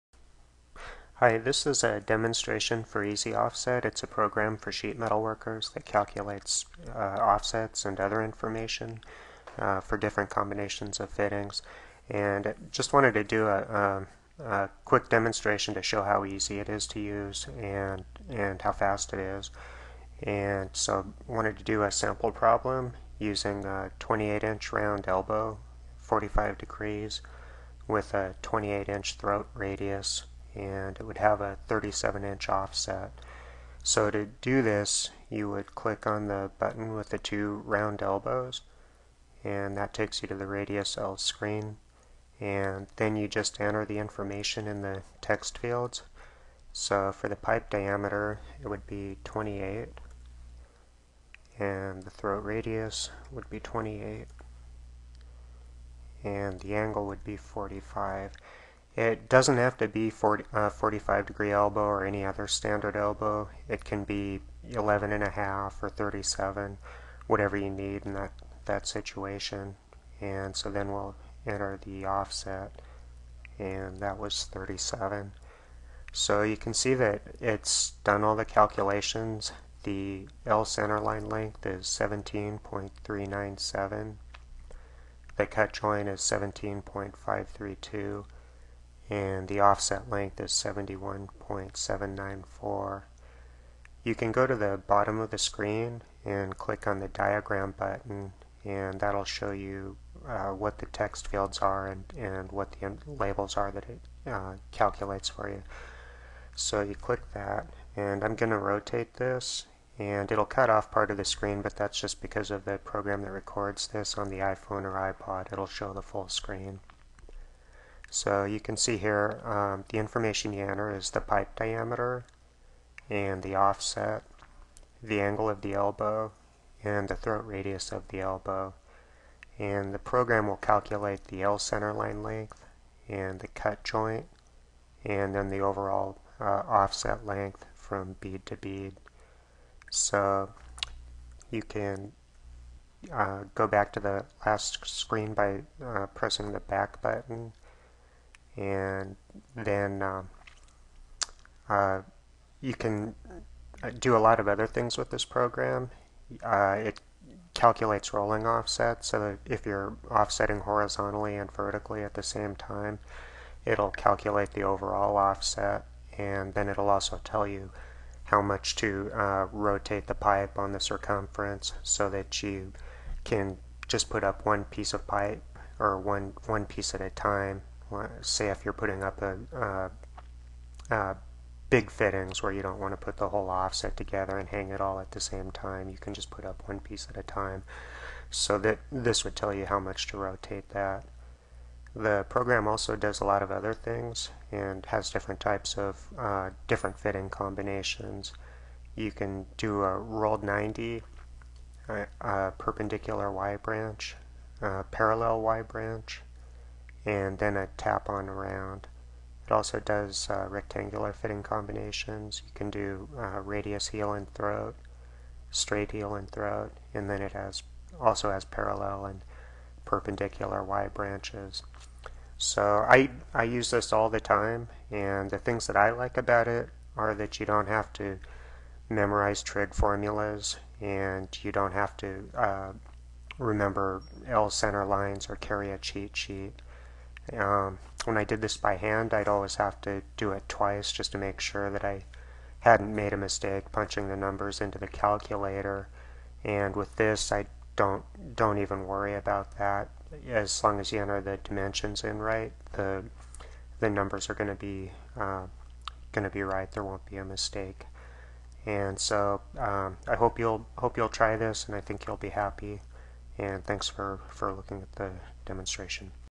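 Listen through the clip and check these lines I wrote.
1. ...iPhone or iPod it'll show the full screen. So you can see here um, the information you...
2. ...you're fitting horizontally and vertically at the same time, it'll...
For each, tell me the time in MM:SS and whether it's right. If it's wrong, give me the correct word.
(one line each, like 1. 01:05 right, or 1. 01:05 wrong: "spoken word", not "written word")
1. 01:54 right
2. 02:39 wrong: "offsetting", not "fitting".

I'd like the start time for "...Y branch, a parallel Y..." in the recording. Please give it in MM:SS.
03:23.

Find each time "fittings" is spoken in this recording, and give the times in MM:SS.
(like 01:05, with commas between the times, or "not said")
00:11, 03:01, 03:16, 03:31.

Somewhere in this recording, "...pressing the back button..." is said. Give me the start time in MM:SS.
02:26.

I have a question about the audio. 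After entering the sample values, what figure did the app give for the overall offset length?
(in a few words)
71.794.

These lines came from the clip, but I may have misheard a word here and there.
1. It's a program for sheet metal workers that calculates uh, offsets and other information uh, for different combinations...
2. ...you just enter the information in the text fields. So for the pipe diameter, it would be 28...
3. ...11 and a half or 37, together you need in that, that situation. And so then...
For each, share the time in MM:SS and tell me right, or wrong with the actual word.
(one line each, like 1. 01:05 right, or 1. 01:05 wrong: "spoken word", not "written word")
1. 00:03 right
2. 00:43 right
3. 01:04 wrong: "whatever", not "together".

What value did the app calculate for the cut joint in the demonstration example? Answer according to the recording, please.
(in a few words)
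17.532.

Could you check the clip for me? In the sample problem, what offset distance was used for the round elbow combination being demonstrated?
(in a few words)
37 inches.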